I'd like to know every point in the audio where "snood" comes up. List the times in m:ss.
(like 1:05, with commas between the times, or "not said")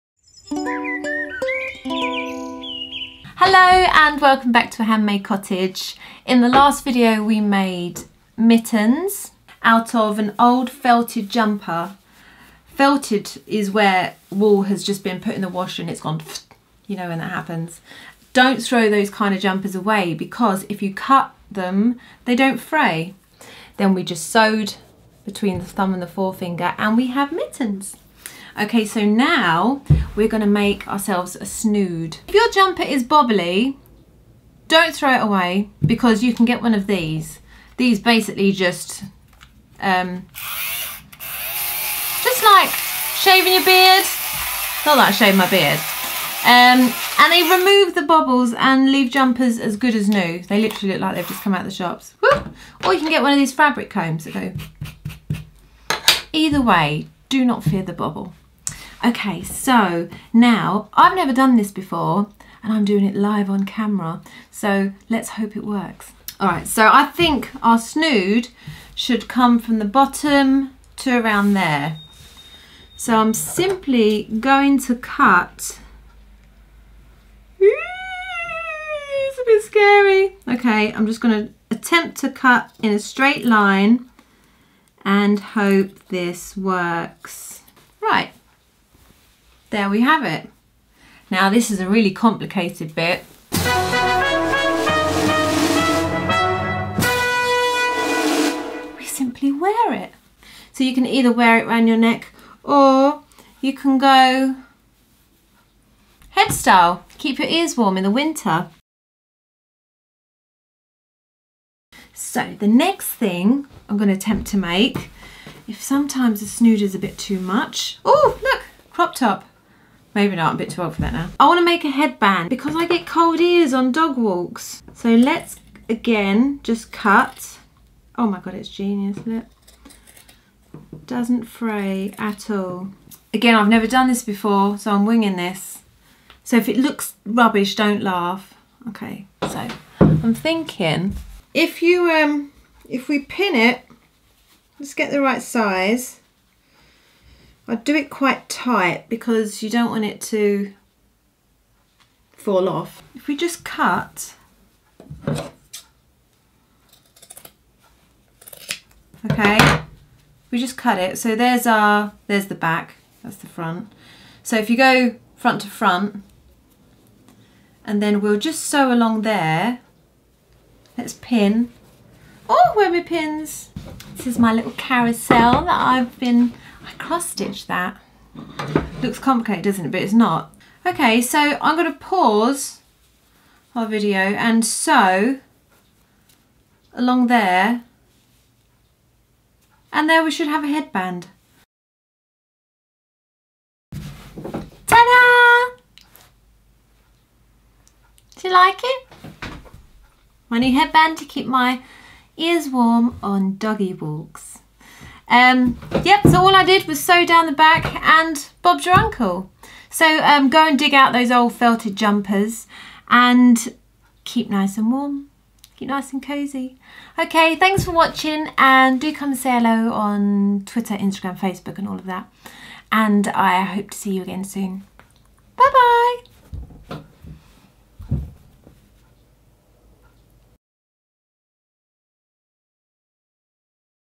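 0:31, 1:07, 1:56.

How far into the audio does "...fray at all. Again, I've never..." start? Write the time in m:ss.
2:11.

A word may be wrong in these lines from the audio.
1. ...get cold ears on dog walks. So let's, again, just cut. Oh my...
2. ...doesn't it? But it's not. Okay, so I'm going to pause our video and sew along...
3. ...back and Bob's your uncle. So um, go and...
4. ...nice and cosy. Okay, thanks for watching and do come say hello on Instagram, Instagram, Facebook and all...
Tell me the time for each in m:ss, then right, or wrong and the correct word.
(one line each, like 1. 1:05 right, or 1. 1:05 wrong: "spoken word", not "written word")
1. 2:02 right
2. 2:59 right
3. 3:27 right
4. 3:35 wrong: "Twitter", not "Instagram".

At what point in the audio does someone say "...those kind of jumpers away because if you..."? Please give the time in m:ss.
0:18.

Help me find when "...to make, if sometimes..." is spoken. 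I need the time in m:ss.
1:54.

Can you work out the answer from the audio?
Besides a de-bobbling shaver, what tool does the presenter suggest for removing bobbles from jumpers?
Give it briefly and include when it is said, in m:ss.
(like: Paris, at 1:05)
Fabric combs, at 0:53.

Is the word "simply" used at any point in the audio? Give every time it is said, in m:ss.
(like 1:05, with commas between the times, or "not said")
1:13, 1:39.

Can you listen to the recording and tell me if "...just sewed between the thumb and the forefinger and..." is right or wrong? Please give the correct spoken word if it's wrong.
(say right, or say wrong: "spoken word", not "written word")
right.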